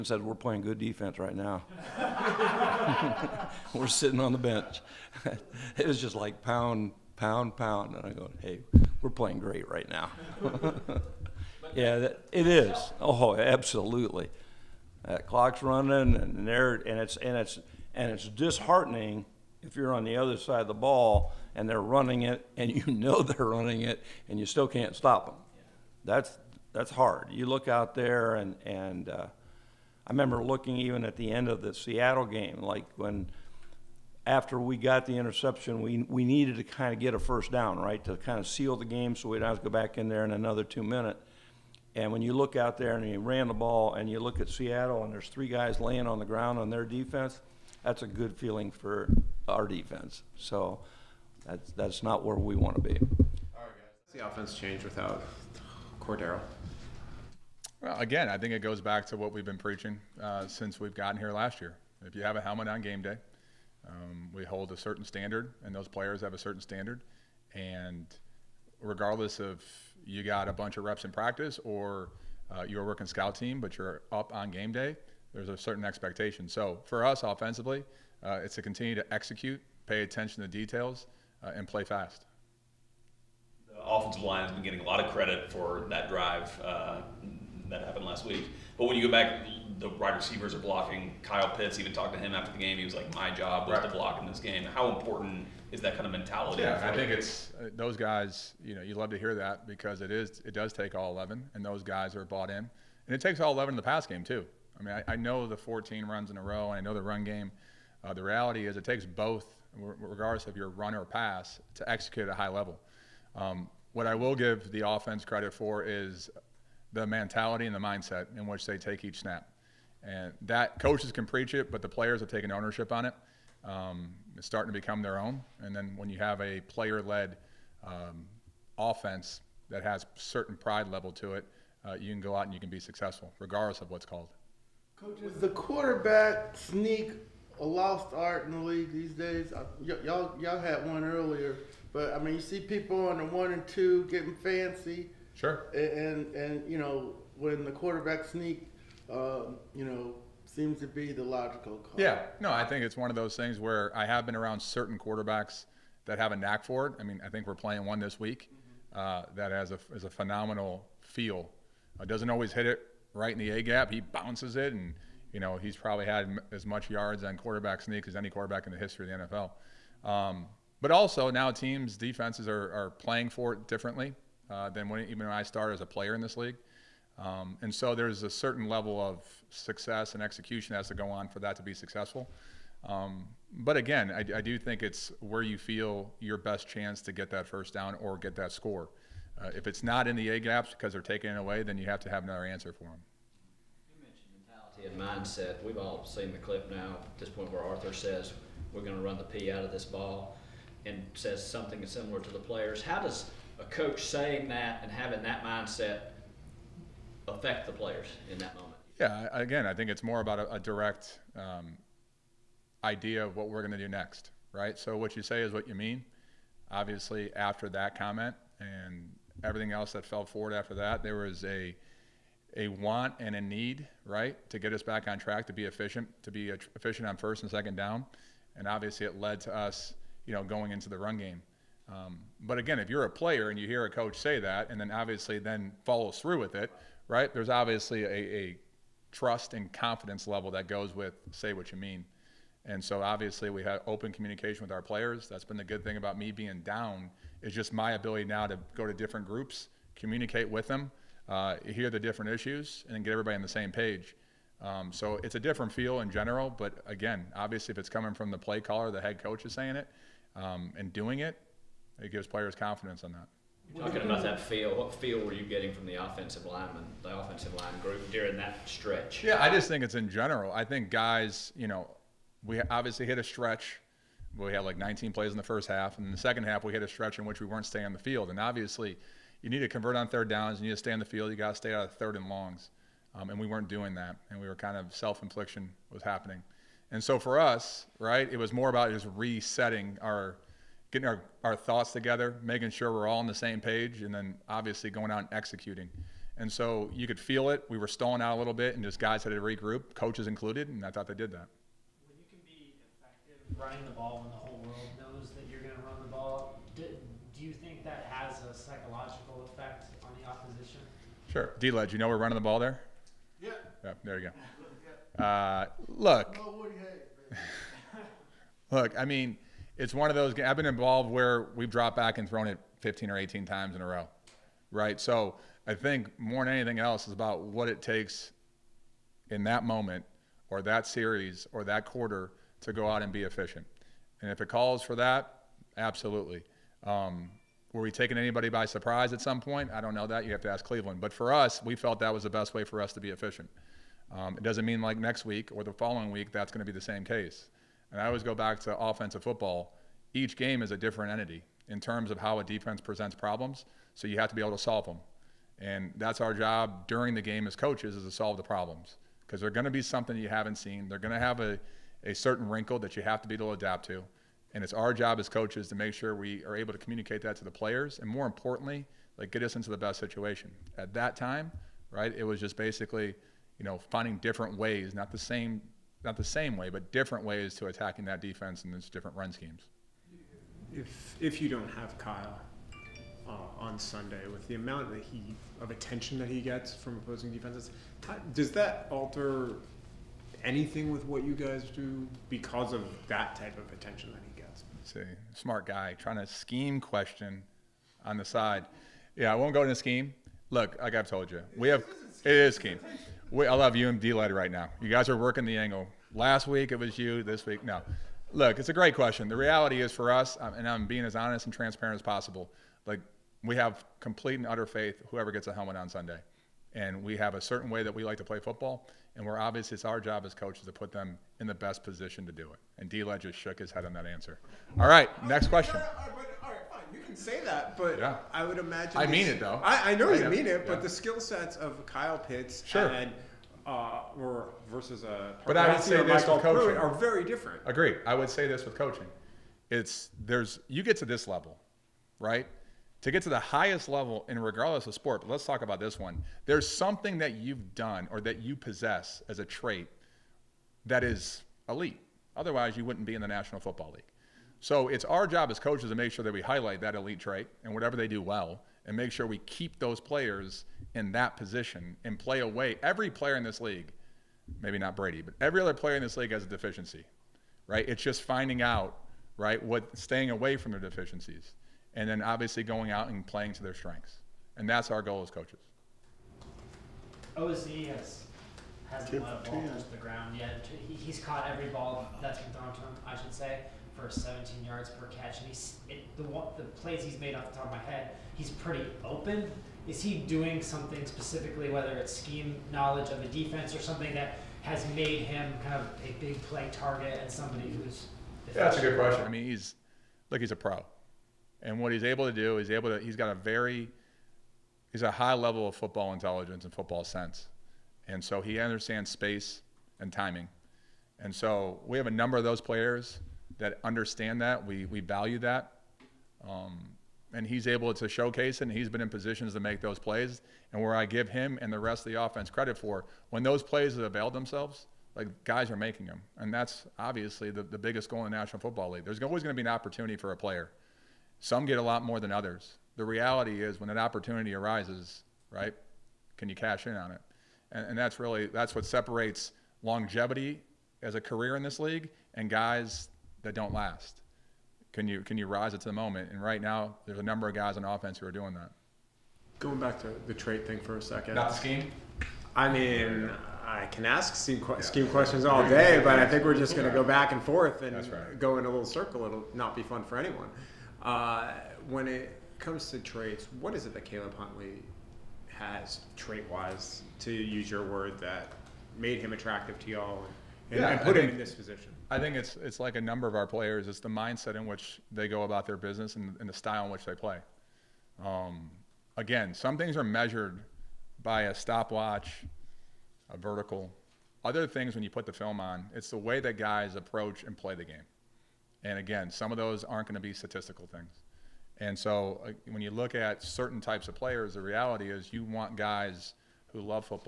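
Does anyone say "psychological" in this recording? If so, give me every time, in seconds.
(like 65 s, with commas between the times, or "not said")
308 s.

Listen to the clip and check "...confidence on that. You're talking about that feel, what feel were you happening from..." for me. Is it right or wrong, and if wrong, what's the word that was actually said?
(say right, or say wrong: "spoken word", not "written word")
wrong: "getting", not "happening".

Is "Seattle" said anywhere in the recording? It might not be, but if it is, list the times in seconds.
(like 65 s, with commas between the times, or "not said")
31 s, 44 s.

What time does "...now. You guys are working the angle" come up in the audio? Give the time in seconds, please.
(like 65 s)
404 s.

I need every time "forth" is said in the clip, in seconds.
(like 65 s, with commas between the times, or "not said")
557 s.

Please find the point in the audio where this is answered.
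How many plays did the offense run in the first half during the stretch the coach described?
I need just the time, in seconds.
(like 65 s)
274 s.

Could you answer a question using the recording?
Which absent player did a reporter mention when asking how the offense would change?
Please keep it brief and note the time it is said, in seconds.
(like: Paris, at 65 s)
Cordarrelle, at 56 s.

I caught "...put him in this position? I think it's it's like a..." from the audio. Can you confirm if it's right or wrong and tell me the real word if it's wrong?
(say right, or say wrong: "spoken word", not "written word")
right.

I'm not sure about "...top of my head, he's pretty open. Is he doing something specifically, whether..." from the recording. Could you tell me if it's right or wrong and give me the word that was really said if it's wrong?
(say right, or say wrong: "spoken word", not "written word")
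right.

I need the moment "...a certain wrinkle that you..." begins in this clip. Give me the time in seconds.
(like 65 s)
362 s.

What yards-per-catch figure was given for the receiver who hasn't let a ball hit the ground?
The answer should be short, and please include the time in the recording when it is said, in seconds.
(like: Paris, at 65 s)
17, at 484 s.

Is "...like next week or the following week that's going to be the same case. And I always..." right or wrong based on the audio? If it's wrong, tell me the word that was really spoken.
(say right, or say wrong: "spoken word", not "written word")
right.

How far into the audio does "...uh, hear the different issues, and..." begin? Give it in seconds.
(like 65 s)
251 s.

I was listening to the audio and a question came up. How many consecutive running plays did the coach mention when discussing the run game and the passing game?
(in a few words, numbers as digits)
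14.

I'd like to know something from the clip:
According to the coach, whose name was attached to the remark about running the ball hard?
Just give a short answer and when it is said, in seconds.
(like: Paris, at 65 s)
Arthur, at 197 s.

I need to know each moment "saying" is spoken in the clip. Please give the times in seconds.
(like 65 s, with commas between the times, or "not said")
204 s, 259 s.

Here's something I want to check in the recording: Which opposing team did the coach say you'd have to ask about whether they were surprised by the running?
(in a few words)
Cleveland.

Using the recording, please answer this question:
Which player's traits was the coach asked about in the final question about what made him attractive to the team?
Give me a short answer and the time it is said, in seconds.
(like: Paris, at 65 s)
Caleb Huntley, at 564 s.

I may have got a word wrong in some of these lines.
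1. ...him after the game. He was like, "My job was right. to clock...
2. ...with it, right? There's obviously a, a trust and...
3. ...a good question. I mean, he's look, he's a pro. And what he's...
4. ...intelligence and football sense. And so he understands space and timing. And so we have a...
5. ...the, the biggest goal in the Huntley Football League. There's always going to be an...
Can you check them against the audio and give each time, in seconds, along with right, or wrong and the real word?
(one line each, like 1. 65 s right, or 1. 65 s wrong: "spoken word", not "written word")
1. 92 s wrong: "block", not "clock"
2. 236 s right
3. 498 s right
4. 506 s right
5. 527 s wrong: "National", not "Huntley".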